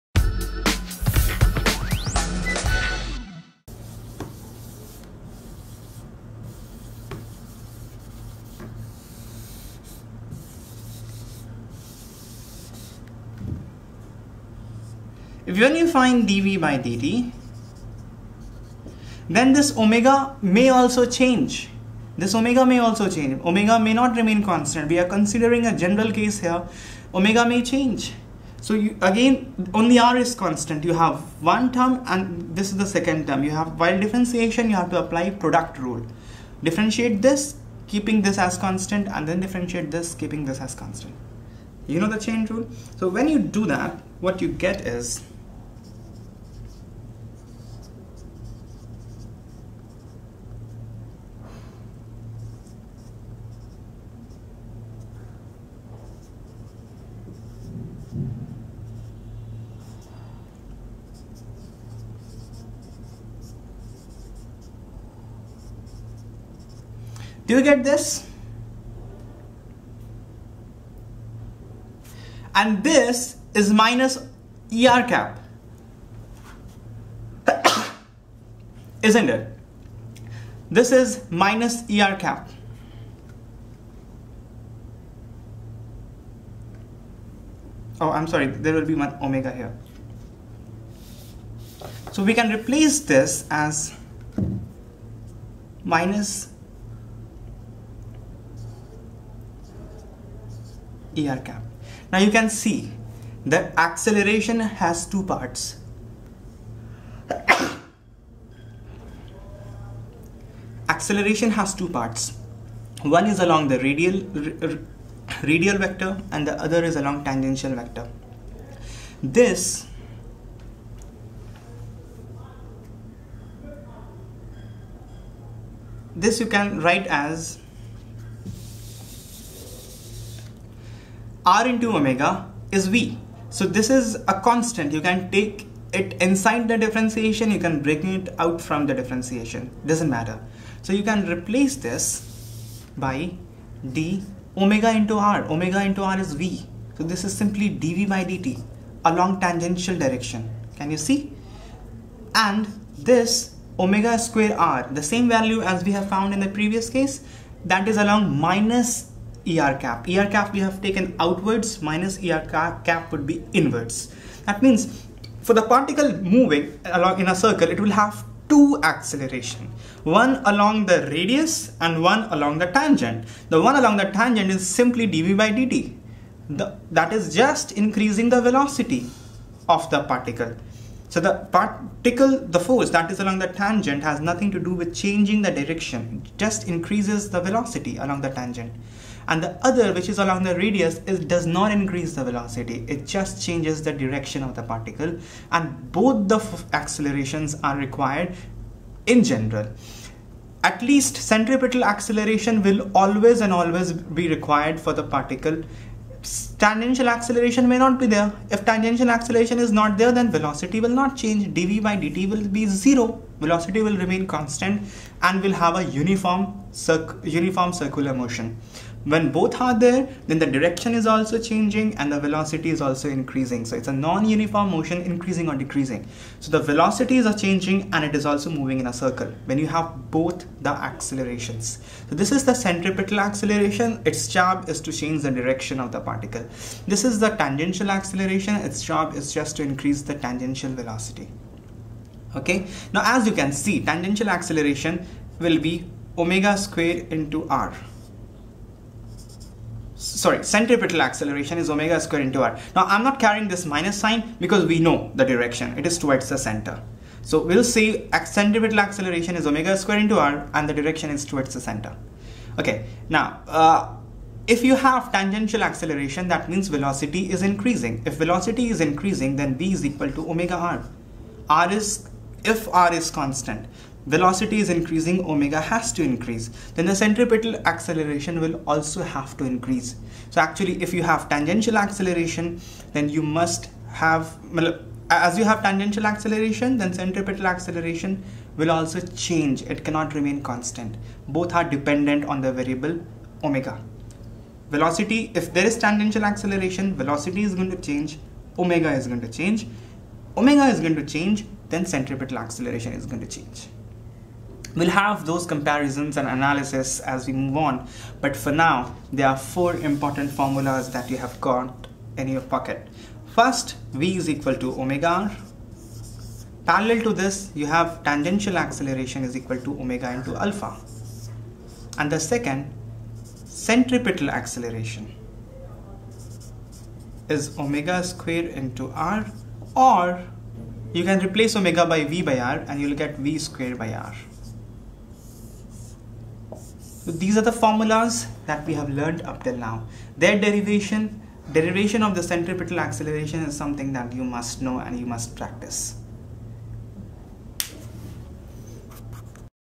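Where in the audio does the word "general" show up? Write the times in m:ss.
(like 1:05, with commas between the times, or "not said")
0:25, 3:19.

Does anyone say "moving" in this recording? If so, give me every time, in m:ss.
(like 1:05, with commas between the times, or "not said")
2:46, 3:48.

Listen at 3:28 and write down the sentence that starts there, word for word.
If tangential acceleration is not there, then velocity will not change.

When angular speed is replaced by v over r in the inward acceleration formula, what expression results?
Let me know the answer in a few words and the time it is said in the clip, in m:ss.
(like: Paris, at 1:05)
v square by r, at 5:33.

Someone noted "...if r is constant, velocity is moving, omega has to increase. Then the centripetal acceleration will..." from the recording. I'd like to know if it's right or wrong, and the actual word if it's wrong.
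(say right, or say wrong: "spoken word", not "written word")
wrong: "increasing", not "moving".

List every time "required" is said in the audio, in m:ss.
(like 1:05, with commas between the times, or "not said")
3:17, 3:24.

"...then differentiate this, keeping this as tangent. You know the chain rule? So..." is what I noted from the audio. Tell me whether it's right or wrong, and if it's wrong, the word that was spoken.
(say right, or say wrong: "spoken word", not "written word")
wrong: "constant", not "tangent".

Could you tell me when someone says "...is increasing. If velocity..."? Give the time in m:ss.
4:27.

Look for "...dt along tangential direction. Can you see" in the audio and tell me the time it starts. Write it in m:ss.
2:28.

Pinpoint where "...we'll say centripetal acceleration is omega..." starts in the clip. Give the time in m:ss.
4:17.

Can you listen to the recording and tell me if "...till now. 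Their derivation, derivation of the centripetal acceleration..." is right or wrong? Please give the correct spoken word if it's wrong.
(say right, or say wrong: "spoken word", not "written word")
right.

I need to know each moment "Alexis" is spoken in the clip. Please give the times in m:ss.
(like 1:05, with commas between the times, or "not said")
not said.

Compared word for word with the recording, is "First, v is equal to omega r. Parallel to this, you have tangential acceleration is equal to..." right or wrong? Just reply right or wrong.
right.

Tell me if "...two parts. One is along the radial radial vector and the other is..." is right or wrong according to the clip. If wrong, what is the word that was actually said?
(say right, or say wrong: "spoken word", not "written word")
right.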